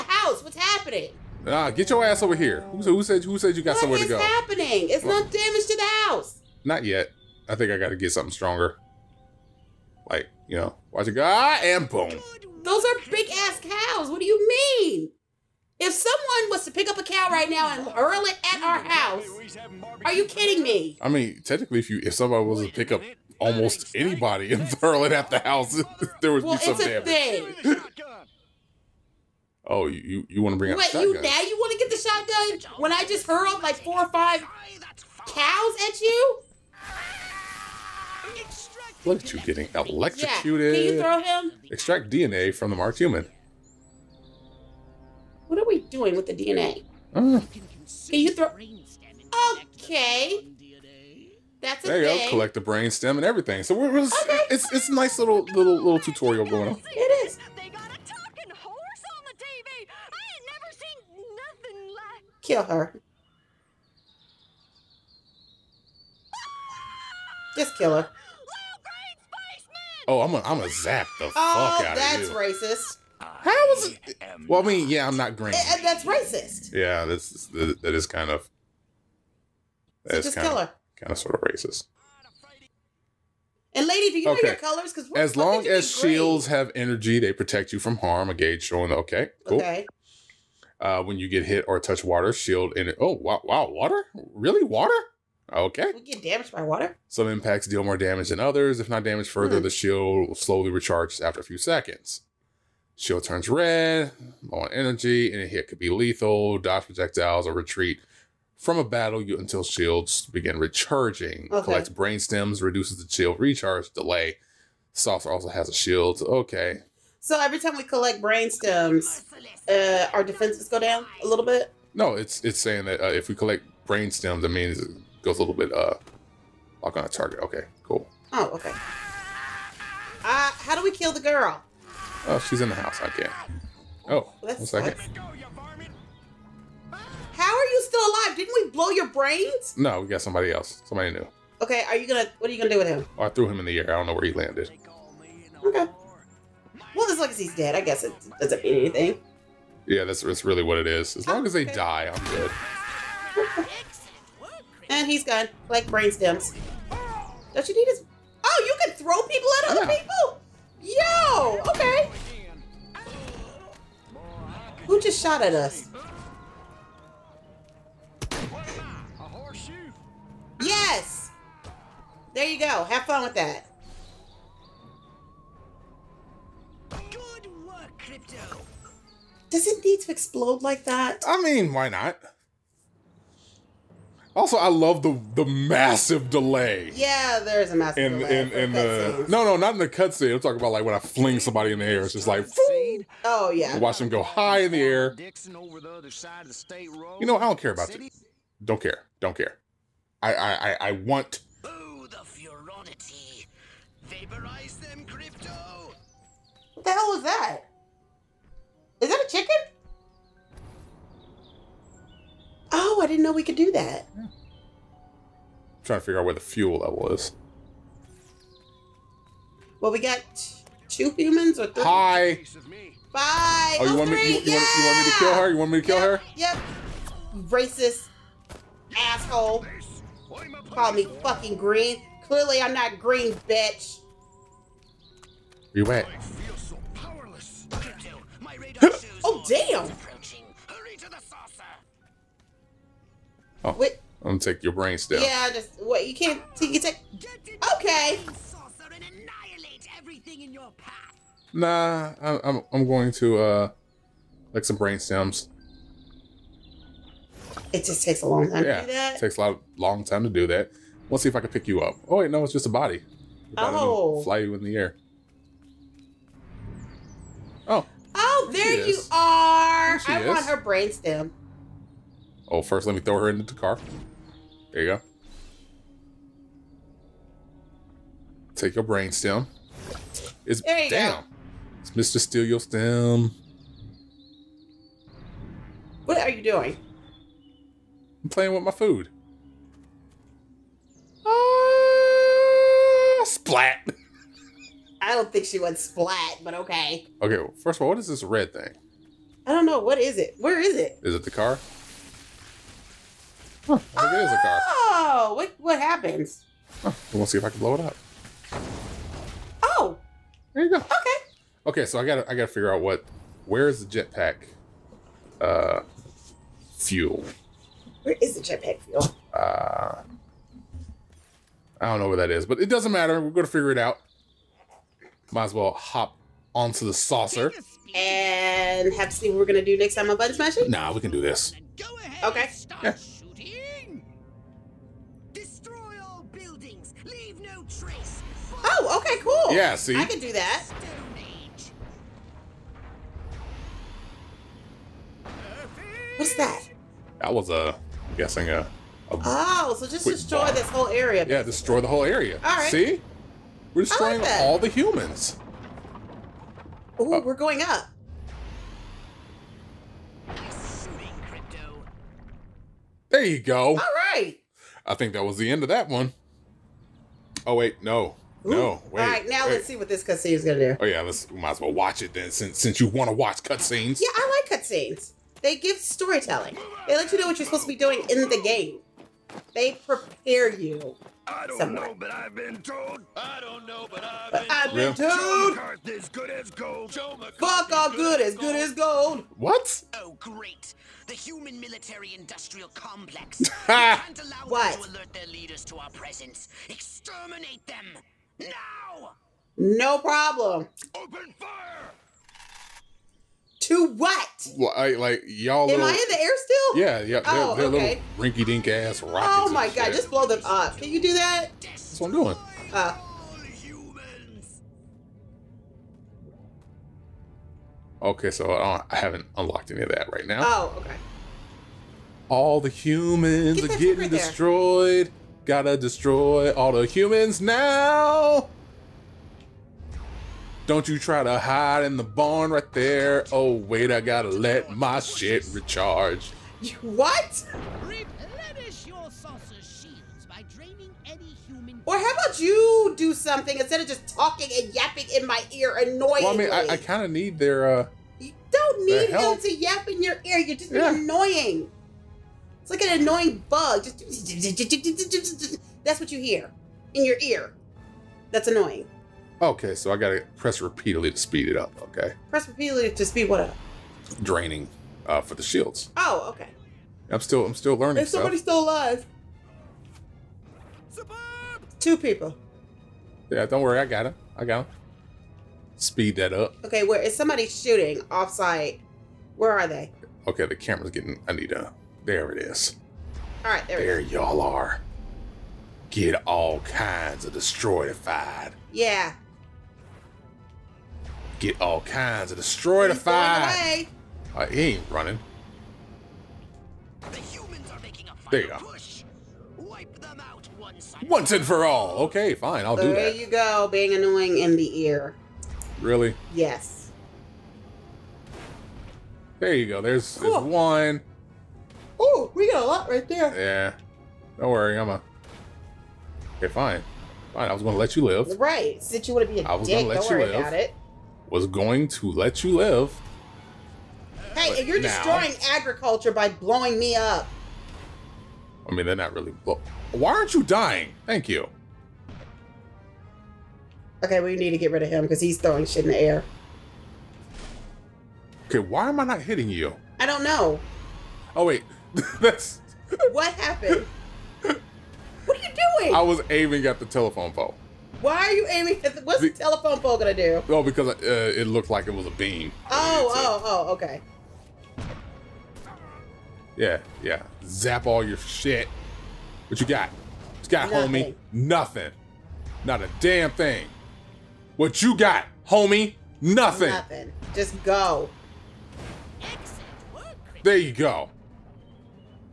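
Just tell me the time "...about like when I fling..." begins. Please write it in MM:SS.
03:10.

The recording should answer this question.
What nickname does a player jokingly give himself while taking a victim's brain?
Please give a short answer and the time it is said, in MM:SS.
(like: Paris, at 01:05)
Mr. Steal Your Stem, at 04:41.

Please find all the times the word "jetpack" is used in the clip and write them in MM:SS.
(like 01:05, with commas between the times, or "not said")
05:13, 05:18.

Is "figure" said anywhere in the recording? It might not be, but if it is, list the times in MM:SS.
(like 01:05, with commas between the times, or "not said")
03:36, 05:12, 05:23.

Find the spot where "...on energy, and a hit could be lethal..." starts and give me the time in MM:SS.
01:44.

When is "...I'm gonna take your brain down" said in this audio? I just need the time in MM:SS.
04:04.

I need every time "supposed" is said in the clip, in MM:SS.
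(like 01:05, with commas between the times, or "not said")
06:17.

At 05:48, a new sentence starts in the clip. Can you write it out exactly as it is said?
a oh, so just destroy this whole area.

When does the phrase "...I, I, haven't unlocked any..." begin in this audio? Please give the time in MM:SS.
06:58.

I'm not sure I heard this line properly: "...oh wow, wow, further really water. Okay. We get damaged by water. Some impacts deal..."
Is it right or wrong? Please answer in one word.
wrong.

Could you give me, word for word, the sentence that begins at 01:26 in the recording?
have energy, they protect you from harm.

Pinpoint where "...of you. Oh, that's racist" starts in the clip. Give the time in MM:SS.
01:11.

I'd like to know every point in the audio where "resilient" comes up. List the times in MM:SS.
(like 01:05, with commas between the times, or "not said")
not said.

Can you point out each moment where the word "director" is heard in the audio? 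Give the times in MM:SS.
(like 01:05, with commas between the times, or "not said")
not said.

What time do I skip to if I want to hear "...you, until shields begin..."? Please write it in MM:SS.
01:49.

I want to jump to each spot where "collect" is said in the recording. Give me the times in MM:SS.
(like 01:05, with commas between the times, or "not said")
00:52, 01:57, 02:03.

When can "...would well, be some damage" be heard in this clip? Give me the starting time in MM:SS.
00:26.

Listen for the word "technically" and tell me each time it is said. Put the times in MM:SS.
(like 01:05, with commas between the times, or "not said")
00:21.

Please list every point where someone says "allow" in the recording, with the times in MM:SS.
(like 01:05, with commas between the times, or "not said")
06:34.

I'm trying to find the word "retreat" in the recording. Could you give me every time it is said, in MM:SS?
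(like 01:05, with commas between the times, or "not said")
01:47.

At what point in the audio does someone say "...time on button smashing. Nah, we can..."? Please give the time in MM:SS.
05:29.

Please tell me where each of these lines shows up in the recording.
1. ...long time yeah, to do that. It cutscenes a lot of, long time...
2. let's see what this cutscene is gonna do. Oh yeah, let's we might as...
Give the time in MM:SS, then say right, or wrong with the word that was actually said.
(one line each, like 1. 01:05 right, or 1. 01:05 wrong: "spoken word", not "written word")
1. 04:18 wrong: "takes", not "cutscenes"
2. 06:09 right.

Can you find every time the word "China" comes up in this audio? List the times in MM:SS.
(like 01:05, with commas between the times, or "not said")
not said.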